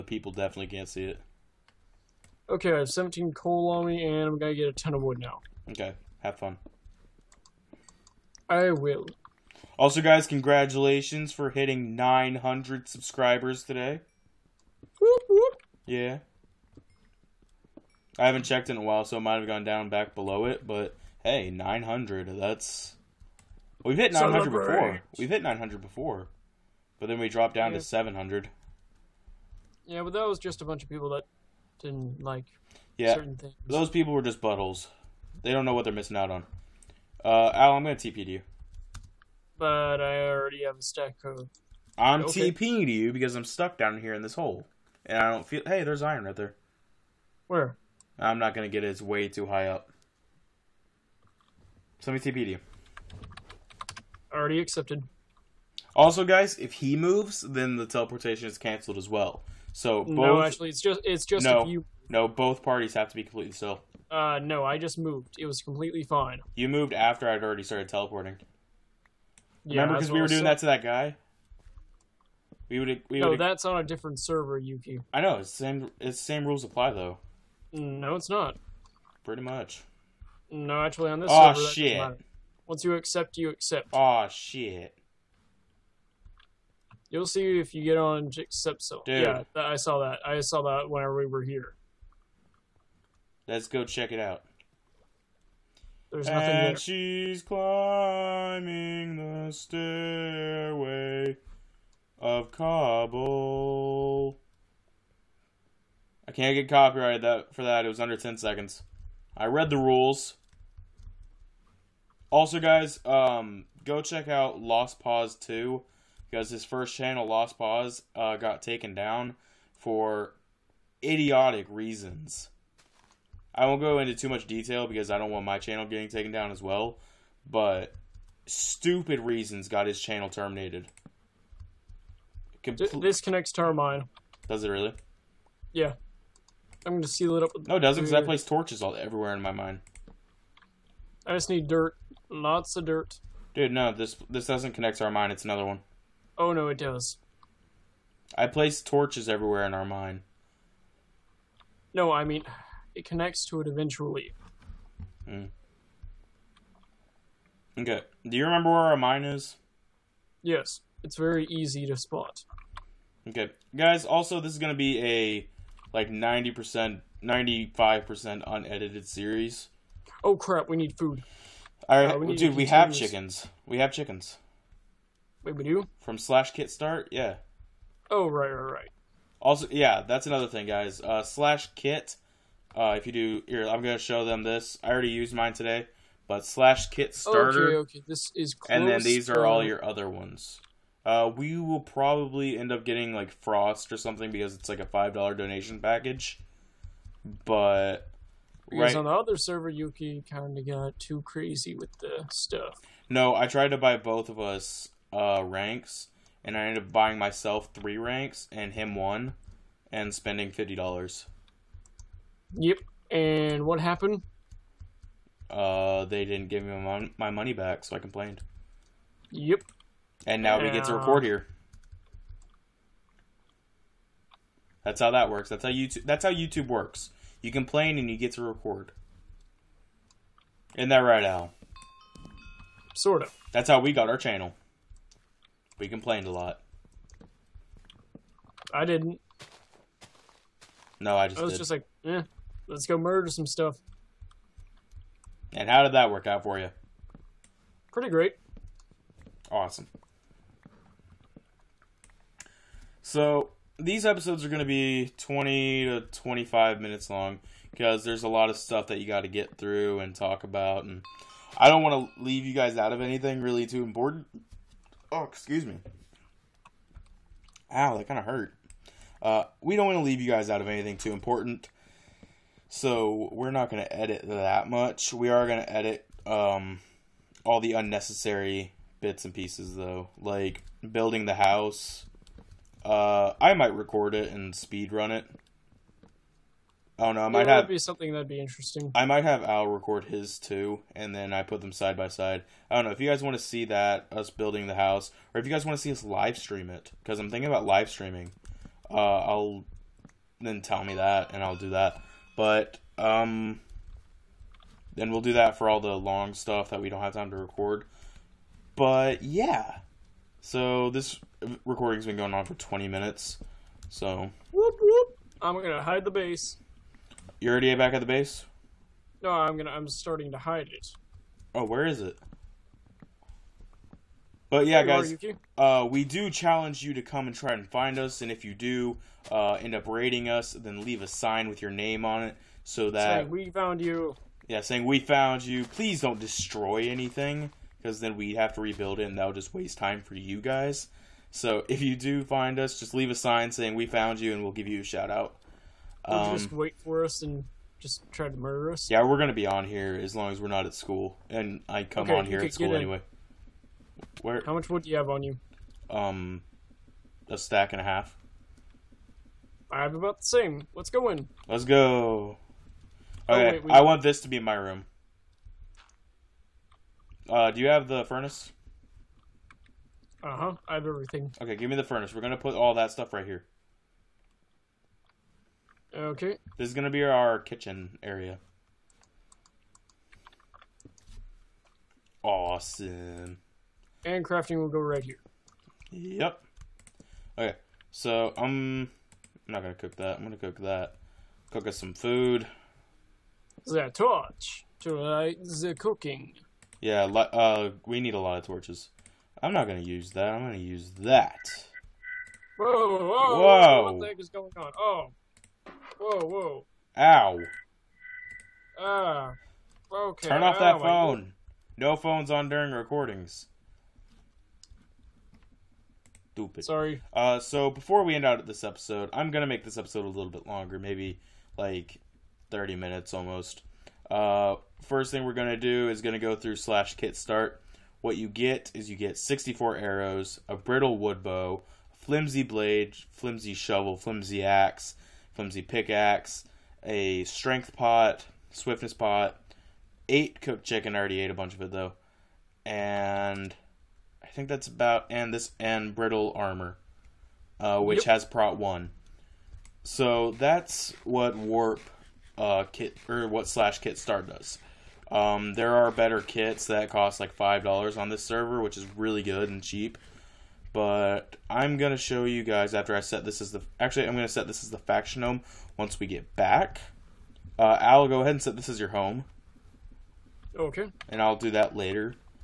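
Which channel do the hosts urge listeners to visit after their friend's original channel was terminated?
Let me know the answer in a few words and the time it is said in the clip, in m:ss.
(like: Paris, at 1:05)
Lost Paws 2, at 1:54.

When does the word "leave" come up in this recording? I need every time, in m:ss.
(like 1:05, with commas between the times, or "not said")
4:22, 4:30, 5:30, 5:42.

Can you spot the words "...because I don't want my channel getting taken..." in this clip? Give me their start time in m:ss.
2:04.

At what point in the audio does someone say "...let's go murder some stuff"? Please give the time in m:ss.
4:02.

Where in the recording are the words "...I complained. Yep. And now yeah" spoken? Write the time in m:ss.
3:37.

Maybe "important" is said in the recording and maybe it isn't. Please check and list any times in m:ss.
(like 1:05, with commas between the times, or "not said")
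4:23, 4:31.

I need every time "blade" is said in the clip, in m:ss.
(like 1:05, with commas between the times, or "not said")
7:12.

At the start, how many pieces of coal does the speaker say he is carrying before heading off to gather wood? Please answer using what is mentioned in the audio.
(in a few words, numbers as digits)
17.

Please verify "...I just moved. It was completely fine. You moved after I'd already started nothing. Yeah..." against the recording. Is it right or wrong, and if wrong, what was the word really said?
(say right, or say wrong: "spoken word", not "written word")
wrong: "teleporting", not "nothing".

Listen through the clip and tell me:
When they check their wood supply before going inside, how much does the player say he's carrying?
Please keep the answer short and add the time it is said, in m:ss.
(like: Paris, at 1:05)
A stack and a half, at 5:57.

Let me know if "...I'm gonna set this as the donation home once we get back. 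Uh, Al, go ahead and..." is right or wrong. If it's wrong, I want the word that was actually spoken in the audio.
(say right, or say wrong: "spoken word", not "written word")
wrong: "faction", not "donation".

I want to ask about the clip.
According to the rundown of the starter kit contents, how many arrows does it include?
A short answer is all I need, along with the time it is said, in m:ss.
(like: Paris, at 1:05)
64, at 7:09.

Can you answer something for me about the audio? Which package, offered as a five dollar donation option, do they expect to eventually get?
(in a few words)
Frost.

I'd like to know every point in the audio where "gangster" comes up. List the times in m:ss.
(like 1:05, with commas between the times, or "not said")
not said.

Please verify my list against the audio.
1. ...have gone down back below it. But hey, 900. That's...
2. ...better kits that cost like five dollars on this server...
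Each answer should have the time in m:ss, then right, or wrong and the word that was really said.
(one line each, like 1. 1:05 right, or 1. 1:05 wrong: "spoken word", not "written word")
1. 0:19 right
2. 7:35 right.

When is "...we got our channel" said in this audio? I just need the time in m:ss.
3:53.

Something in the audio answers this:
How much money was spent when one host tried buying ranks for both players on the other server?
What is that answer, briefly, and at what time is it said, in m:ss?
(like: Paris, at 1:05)
$50, at 3:30.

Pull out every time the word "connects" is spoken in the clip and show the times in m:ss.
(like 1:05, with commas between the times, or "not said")
2:13, 2:24, 2:33.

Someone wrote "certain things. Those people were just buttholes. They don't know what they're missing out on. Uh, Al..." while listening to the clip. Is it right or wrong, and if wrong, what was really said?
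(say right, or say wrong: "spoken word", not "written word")
right.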